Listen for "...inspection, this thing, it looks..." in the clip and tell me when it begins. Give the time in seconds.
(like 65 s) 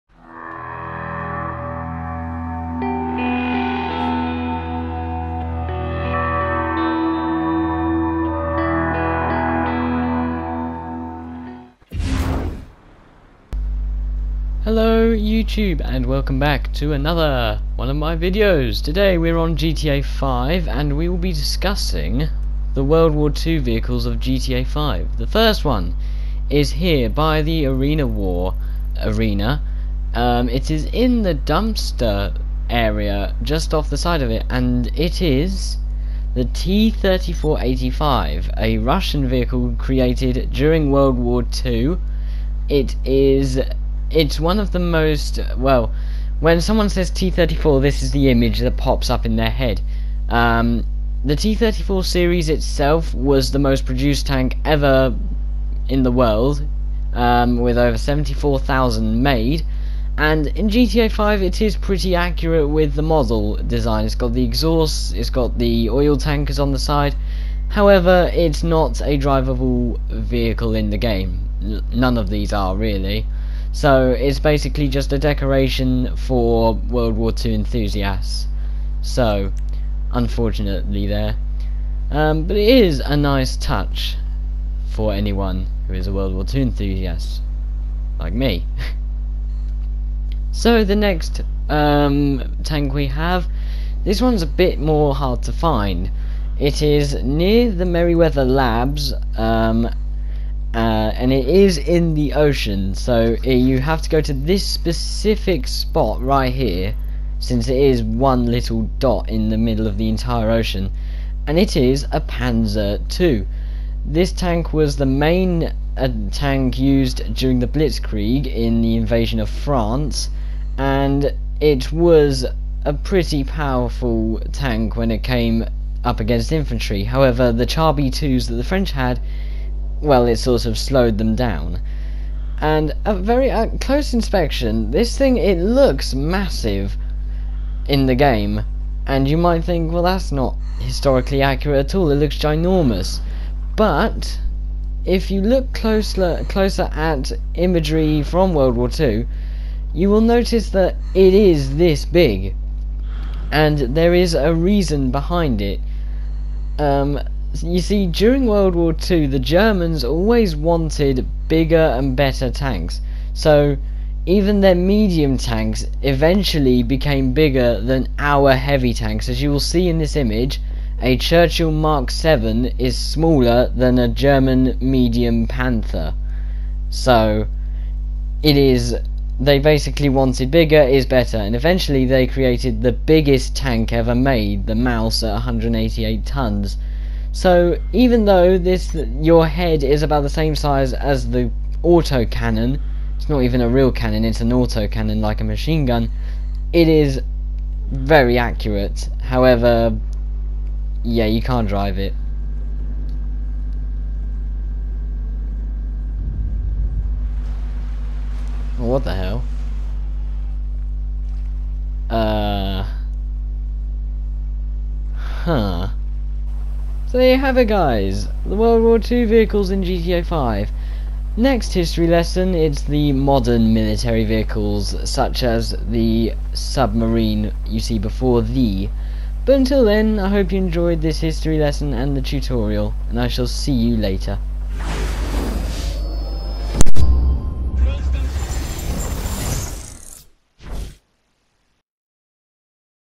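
134 s.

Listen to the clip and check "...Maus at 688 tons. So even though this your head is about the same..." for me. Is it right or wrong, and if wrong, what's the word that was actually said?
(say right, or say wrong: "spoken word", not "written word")
wrong: "188", not "688".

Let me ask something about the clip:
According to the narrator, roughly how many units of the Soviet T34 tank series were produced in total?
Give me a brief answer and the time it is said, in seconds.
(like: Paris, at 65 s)
over 74,000, at 57 s.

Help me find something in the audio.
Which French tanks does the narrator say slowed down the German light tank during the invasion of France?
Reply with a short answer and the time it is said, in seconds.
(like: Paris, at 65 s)
Char B2s, at 127 s.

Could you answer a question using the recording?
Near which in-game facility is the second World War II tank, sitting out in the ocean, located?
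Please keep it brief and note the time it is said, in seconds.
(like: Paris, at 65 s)
Merryweather Labs, at 97 s.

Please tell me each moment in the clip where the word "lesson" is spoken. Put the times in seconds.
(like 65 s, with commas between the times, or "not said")
222 s, 231 s.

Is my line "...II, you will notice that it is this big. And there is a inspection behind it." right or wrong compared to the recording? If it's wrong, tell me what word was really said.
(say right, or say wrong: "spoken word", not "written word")
wrong: "reason", not "inspection".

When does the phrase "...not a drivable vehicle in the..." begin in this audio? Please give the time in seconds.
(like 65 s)
68 s.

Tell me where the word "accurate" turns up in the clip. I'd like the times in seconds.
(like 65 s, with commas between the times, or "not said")
62 s, 141 s, 198 s.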